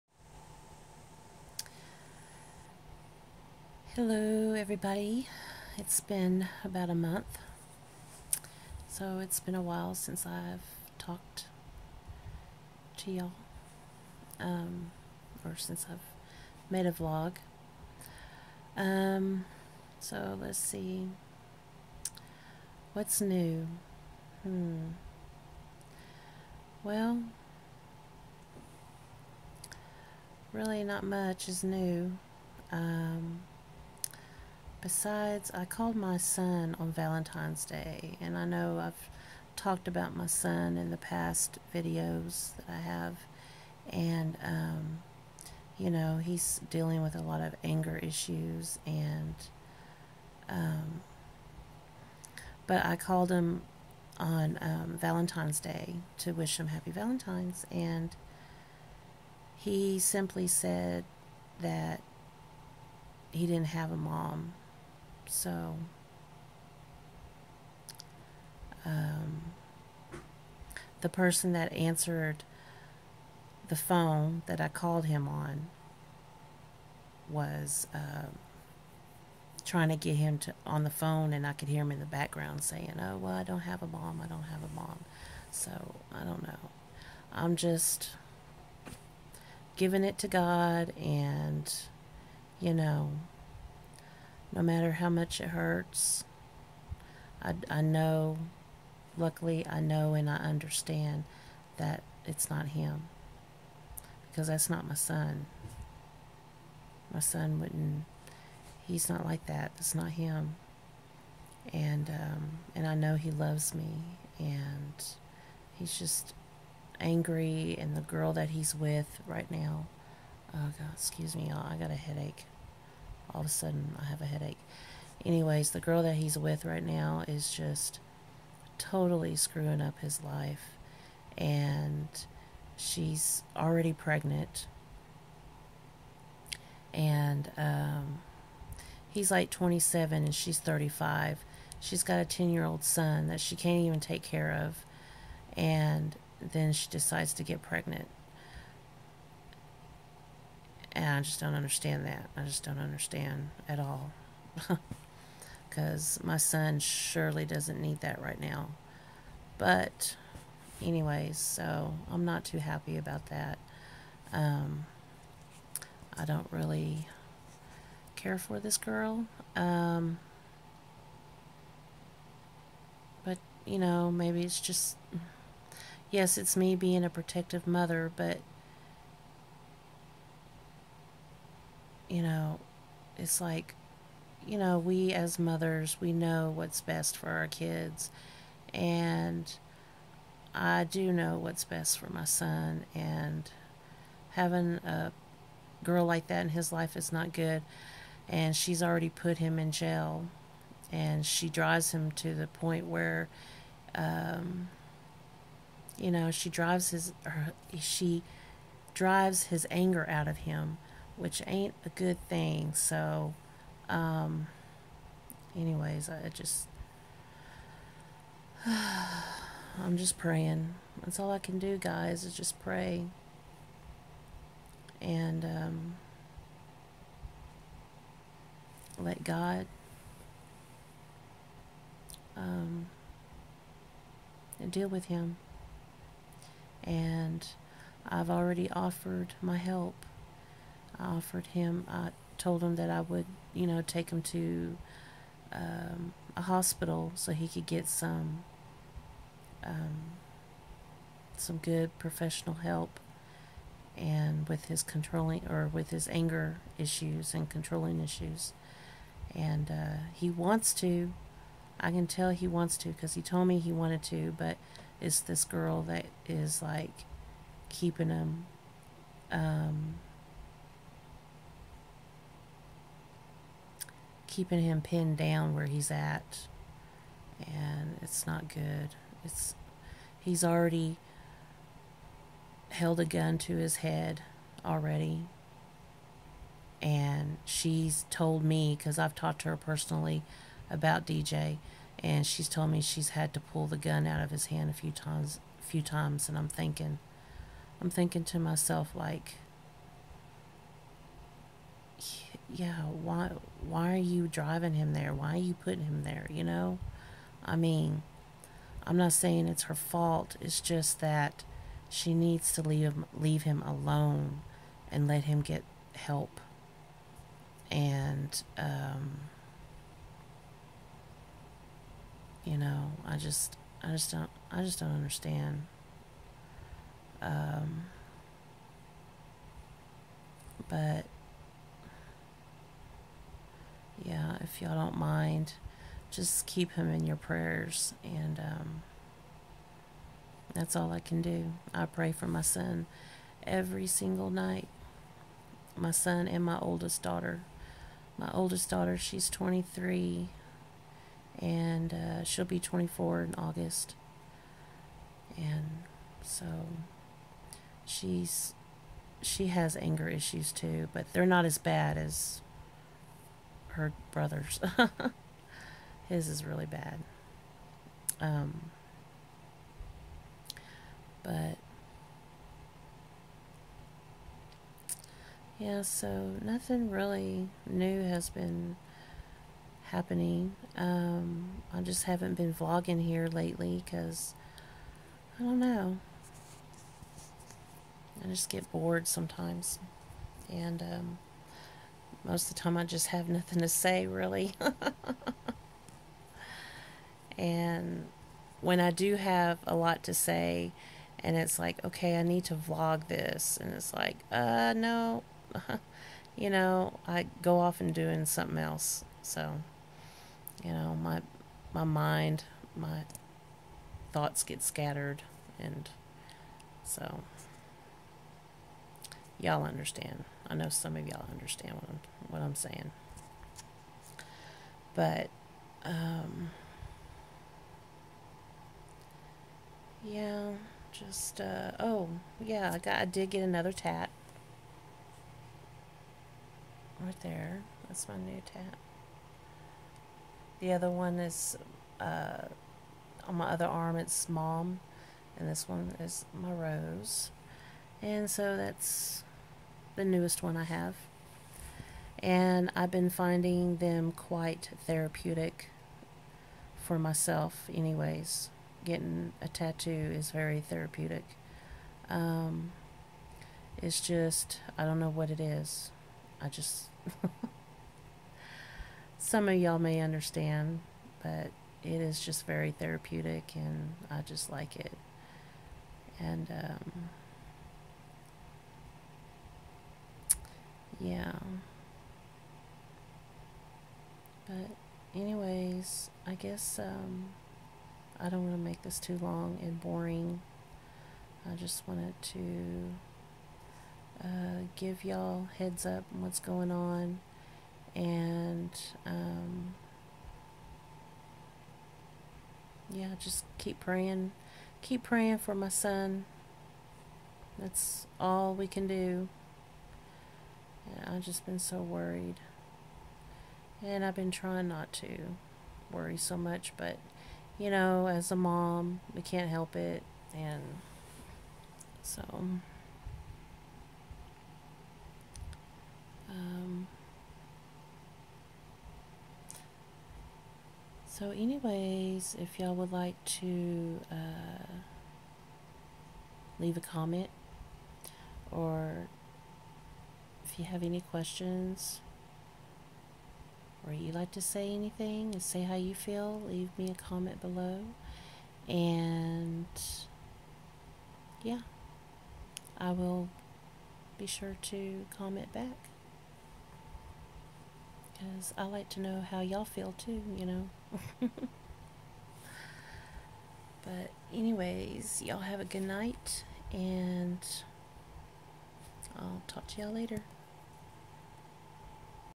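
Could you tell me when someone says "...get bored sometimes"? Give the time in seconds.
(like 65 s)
388 s.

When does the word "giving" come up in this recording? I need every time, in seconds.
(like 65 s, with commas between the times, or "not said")
89 s.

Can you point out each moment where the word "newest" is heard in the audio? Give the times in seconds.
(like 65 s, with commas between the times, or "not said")
450 s.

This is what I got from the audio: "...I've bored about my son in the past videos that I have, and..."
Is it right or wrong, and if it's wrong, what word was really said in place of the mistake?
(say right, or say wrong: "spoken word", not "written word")
wrong: "talked", not "bored".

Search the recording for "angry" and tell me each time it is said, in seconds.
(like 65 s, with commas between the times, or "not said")
116 s.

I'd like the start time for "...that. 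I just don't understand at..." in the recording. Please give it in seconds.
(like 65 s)
152 s.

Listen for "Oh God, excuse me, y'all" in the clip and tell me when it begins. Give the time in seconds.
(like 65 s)
120 s.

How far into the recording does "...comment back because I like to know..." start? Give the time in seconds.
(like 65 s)
555 s.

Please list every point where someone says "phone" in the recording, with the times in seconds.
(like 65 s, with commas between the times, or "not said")
73 s, 80 s.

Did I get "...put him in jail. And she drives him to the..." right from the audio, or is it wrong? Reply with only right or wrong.
right.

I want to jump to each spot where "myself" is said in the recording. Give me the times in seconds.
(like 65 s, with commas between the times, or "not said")
298 s, 456 s.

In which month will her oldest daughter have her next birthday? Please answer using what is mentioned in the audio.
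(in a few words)
August.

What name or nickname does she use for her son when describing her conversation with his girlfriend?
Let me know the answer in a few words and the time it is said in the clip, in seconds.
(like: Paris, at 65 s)
DJ, at 291 s.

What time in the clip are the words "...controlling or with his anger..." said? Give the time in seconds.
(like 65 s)
254 s.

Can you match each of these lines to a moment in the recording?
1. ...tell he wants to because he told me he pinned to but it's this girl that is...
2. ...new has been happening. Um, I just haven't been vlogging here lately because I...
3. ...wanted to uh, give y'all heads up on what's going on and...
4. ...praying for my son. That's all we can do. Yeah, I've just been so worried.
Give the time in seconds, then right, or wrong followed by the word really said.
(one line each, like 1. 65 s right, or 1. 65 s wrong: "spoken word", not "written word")
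1. 262 s wrong: "wanted", not "pinned"
2. 377 s right
3. 491 s right
4. 505 s right.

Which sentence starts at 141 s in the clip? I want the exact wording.
She's got a 10 year old son that she can't even take care of.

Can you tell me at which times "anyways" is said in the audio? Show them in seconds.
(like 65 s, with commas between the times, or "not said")
125 s, 160 s, 215 s, 457 s, 485 s, 531 s, 564 s.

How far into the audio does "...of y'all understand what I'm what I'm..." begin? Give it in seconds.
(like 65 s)
420 s.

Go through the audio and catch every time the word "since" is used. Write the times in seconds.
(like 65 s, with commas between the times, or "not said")
9 s, 15 s.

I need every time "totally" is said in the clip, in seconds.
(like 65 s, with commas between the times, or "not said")
128 s.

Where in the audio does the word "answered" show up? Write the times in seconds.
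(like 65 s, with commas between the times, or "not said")
71 s.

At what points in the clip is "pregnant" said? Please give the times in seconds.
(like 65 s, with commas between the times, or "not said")
133 s, 147 s.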